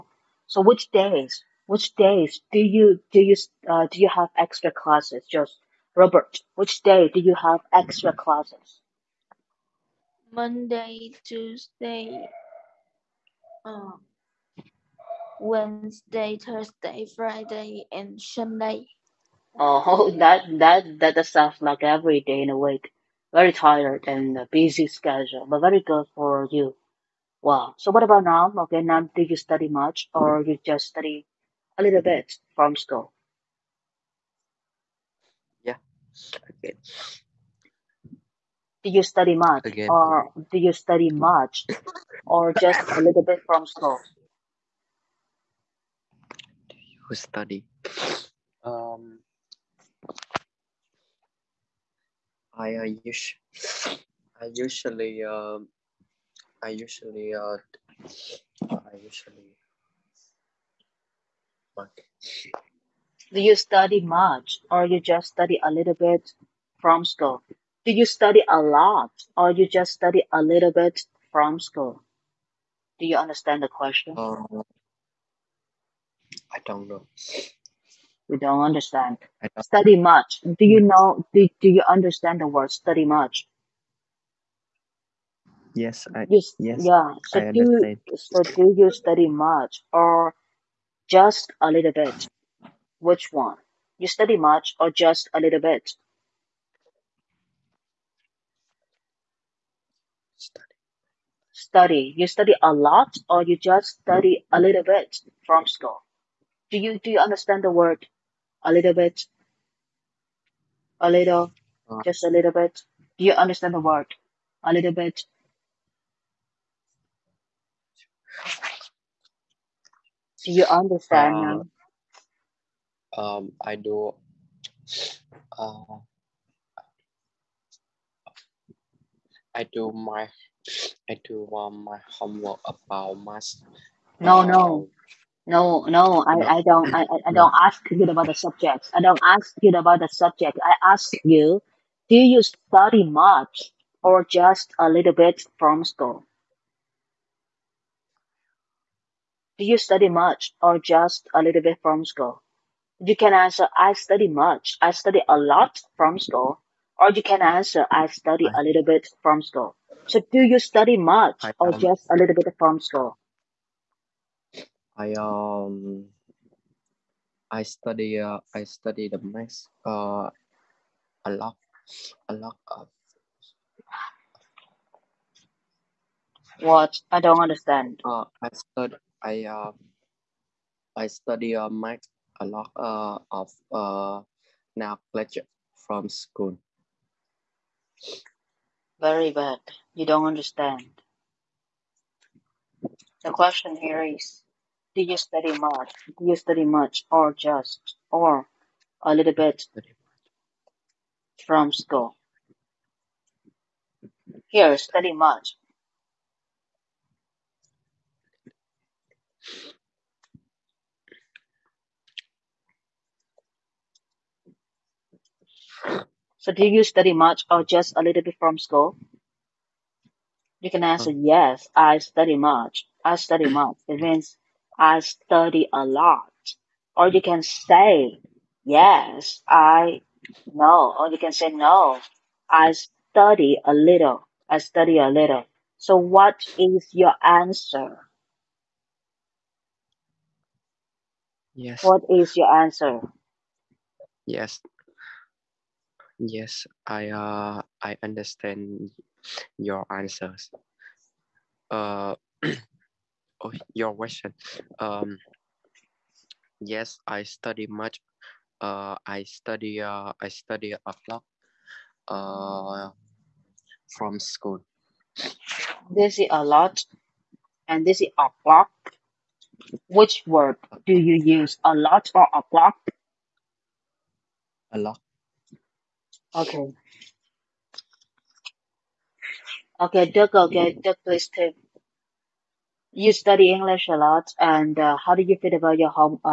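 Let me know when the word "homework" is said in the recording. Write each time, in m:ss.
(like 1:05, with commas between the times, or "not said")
2:12.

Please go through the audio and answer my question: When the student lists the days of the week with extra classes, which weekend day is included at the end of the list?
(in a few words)
Sunday.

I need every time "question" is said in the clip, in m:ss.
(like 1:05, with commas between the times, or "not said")
1:13, 3:13, 4:13.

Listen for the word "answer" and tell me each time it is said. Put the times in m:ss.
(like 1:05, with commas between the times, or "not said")
2:33, 2:37, 3:40, 3:57, 4:02, 4:09.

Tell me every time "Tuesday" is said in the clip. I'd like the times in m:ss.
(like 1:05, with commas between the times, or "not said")
0:11.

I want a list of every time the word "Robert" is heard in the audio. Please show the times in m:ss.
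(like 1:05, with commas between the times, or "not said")
0:05.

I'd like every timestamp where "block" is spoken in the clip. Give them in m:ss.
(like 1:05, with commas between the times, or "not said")
4:32.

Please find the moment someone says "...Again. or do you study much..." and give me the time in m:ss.
0:39.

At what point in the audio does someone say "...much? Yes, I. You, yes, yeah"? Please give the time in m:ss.
1:23.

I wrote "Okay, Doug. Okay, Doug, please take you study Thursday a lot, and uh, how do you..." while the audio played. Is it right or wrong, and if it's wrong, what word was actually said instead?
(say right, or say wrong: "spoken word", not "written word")
wrong: "English", not "Thursday".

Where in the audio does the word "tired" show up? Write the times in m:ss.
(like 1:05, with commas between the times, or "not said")
0:23.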